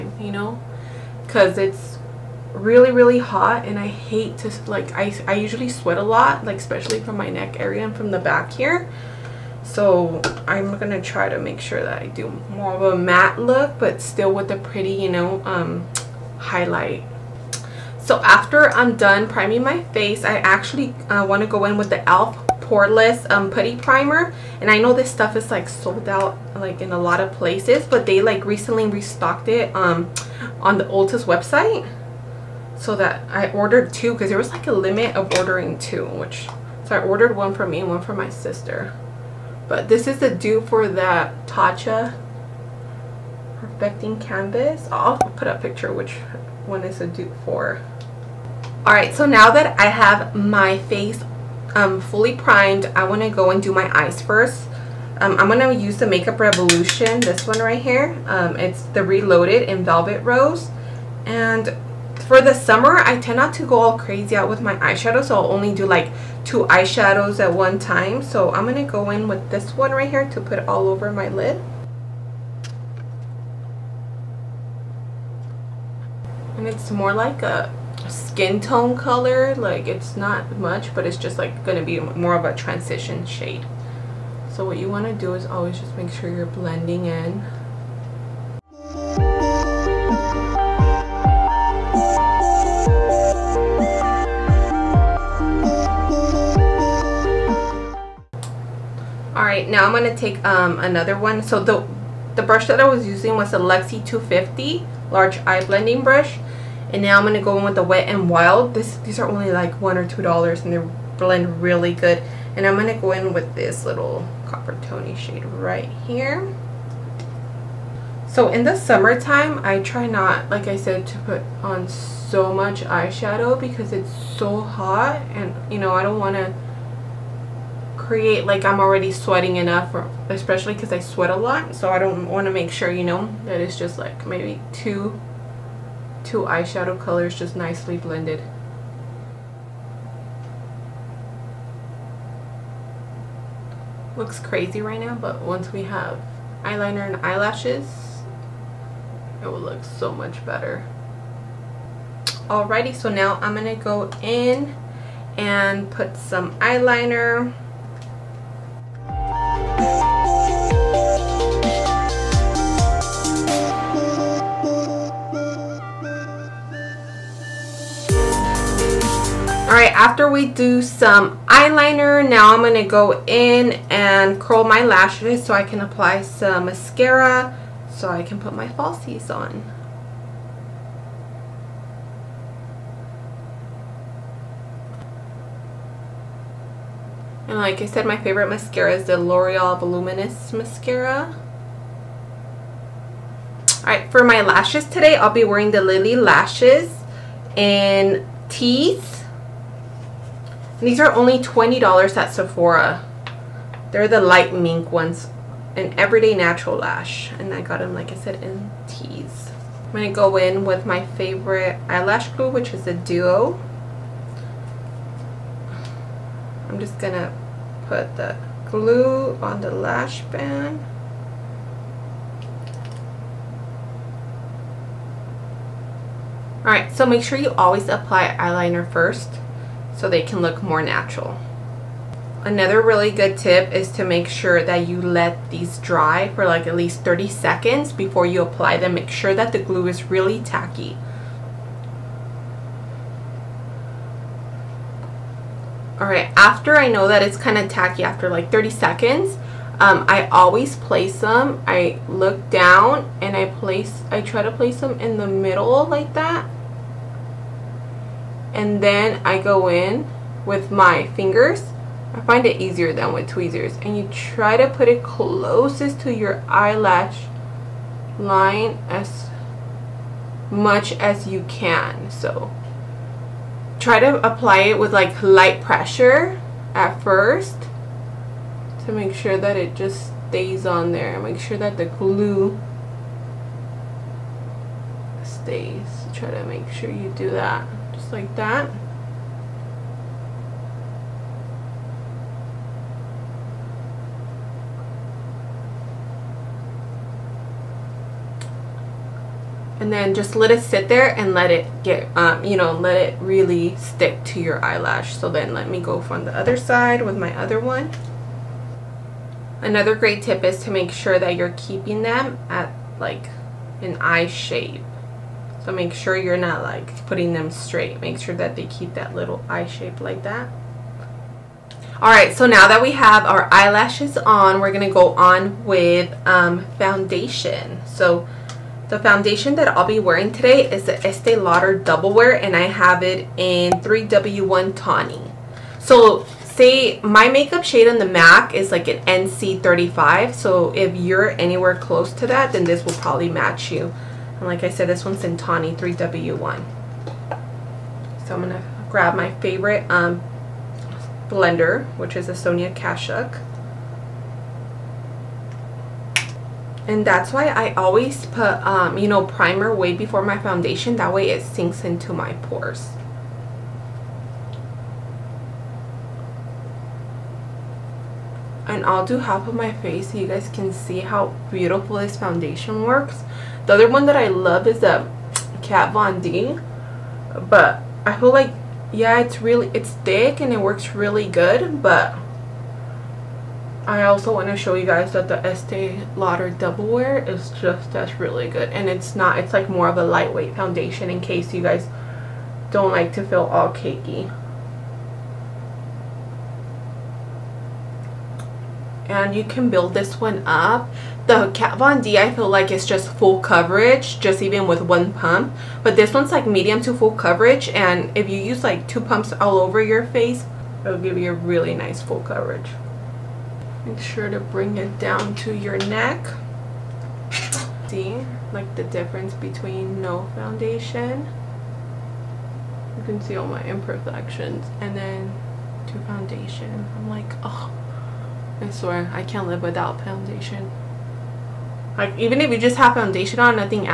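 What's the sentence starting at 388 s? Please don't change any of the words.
And it's not, it's like more of a lightweight foundation in case you guys don't like to feel all cakey.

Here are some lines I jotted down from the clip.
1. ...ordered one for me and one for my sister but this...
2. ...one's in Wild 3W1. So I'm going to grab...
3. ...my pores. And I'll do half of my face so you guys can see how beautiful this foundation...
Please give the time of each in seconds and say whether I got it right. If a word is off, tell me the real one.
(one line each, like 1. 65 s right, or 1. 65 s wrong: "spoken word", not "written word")
1. 37 s right
2. 345 s wrong: "Tawny", not "Wild"
3. 362 s right.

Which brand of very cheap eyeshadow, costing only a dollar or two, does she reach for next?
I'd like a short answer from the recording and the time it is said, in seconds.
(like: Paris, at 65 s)
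Wet and Wild, at 107 s.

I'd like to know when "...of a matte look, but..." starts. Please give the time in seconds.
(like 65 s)
12 s.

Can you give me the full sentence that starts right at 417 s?
See like the difference between no foundation.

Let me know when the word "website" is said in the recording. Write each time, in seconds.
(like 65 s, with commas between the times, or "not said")
31 s.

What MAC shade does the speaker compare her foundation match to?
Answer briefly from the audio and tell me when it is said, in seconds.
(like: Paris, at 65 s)
NC35, at 339 s.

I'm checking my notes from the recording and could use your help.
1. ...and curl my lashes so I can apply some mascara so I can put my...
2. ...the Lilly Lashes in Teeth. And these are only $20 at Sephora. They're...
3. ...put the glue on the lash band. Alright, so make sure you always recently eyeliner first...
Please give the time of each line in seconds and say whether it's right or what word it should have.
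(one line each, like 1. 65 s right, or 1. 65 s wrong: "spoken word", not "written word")
1. 173 s right
2. 195 s right
3. 217 s wrong: "apply", not "recently".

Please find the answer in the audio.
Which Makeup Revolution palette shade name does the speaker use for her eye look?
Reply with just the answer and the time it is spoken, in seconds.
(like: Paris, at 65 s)
Velvet Rose, at 59 s.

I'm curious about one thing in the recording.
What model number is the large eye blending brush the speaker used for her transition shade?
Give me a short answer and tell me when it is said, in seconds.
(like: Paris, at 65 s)
250, at 104 s.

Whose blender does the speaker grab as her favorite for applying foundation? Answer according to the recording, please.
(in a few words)
Sonia Kashuk.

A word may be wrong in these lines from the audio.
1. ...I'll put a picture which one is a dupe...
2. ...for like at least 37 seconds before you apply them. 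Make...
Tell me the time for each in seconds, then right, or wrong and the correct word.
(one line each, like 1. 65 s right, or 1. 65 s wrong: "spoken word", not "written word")
1. 44 s right
2. 236 s wrong: "30", not "37".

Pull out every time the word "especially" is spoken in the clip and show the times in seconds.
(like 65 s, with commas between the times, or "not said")
6 s, 130 s.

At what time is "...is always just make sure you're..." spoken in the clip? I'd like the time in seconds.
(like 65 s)
85 s.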